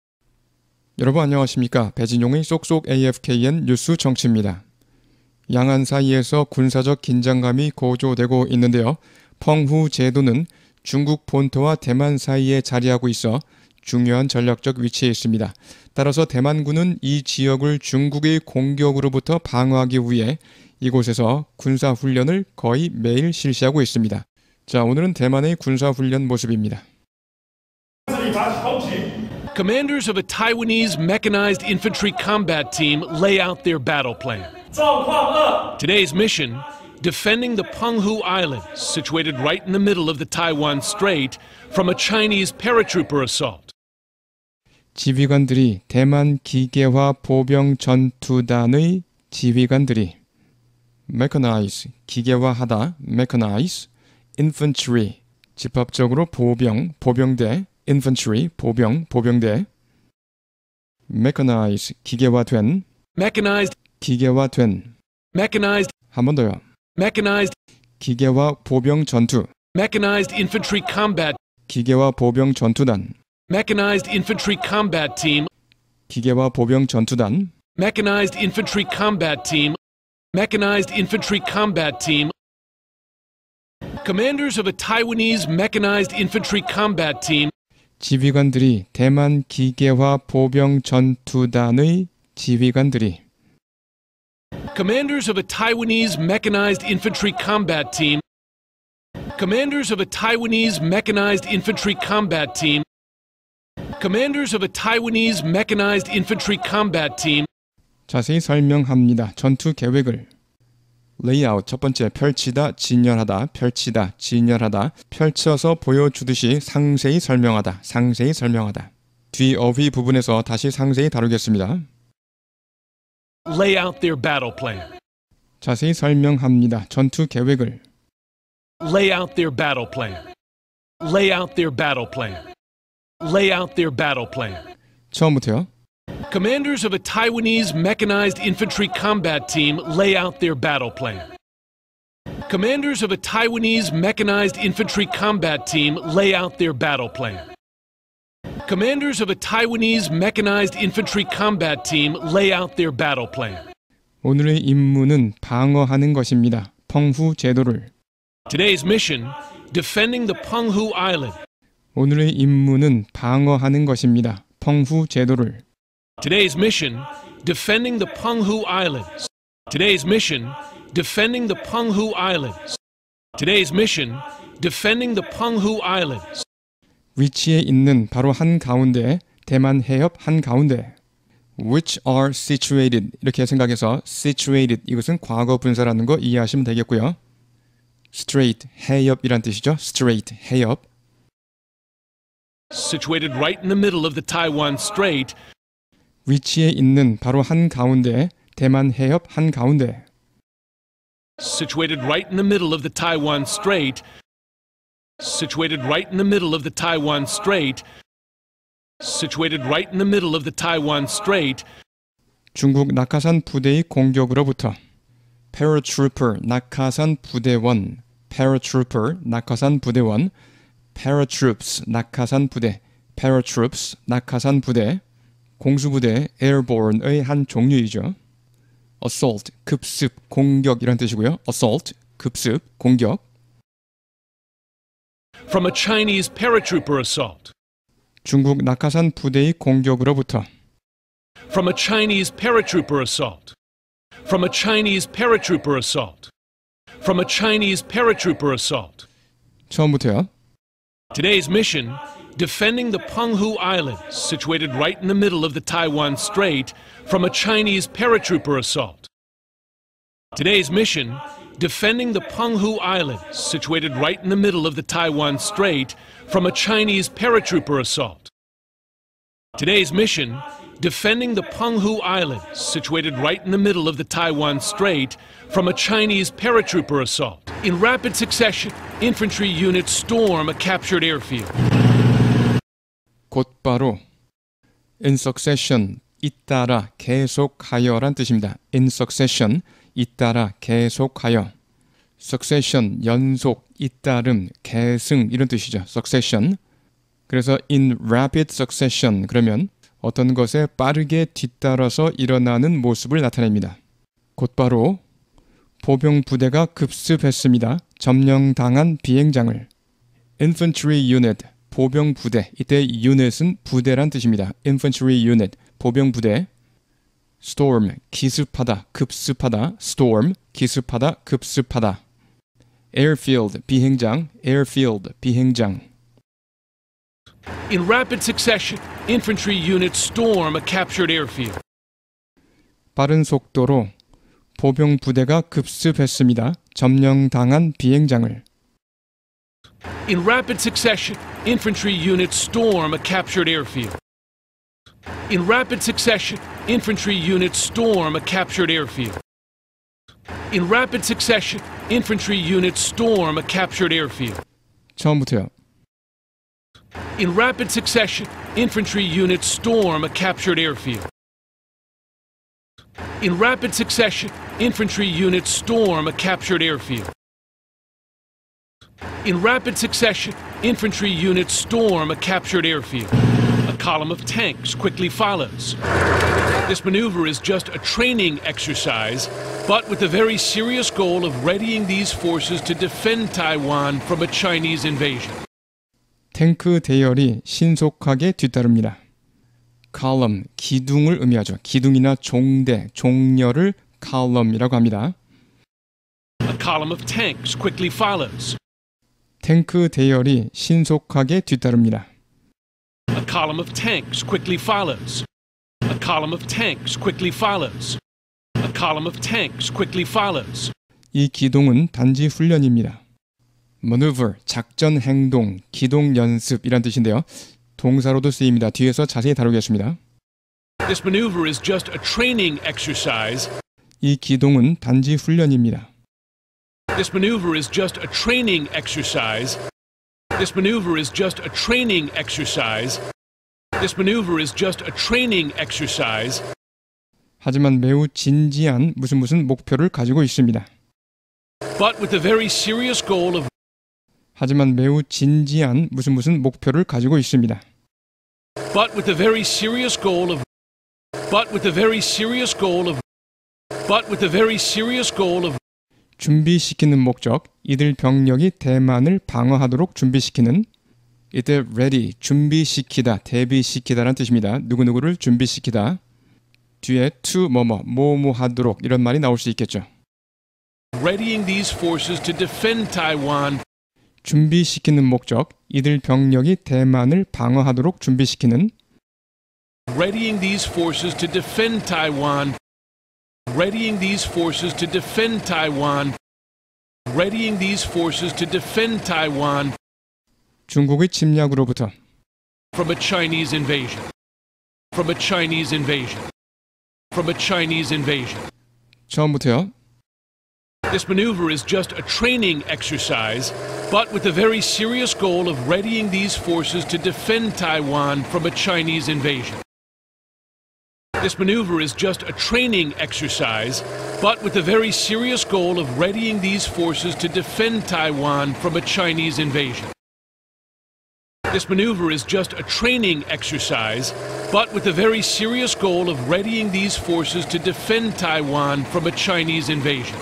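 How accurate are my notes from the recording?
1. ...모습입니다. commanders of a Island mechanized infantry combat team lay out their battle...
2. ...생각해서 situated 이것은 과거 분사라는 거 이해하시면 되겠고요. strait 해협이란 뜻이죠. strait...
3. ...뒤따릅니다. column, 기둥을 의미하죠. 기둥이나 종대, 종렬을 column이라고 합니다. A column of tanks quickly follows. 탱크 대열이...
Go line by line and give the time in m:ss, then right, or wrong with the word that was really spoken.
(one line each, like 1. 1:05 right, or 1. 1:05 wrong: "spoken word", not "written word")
1. 0:26 wrong: "Taiwanese", not "Island"
2. 3:03 right
3. 6:28 right.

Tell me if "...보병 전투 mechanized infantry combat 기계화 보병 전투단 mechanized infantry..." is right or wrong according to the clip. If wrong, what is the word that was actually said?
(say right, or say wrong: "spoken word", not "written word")
right.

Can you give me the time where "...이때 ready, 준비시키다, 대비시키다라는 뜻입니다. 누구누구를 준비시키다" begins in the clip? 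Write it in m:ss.
7:41.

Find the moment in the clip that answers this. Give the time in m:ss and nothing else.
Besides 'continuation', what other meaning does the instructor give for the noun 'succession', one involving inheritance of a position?
4:54.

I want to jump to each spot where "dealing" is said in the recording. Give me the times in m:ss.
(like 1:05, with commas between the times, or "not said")
not said.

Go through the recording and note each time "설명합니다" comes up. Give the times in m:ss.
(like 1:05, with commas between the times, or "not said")
1:48, 2:05.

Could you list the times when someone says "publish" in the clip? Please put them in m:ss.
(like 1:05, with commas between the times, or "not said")
not said.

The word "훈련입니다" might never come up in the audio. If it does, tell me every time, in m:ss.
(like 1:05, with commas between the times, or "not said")
6:52, 7:05.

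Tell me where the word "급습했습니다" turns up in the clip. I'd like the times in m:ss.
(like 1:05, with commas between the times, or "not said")
5:06, 5:35.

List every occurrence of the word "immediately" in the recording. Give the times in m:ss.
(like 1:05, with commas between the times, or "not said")
not said.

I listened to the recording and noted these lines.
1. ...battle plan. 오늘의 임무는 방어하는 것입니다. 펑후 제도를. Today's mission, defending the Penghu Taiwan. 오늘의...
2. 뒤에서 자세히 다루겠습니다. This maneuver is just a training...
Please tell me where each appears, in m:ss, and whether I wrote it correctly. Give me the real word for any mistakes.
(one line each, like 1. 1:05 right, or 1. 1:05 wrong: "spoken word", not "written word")
1. 2:32 wrong: "Island", not "Taiwan"
2. 6:58 right.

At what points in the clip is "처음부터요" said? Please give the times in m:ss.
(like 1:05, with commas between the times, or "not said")
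2:15, 4:09, 5:54, 8:19.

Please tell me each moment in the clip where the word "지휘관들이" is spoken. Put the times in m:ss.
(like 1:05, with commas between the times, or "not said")
0:44, 0:49, 1:28, 1:32.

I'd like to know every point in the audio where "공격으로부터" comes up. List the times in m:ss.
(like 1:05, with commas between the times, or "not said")
0:18, 3:33, 3:59.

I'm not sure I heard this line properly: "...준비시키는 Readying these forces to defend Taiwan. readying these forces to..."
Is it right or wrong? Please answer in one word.
right.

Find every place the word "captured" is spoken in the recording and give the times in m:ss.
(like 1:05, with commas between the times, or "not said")
4:40, 5:30, 5:42, 5:48, 5:53, 6:00, 6:06, 6:12.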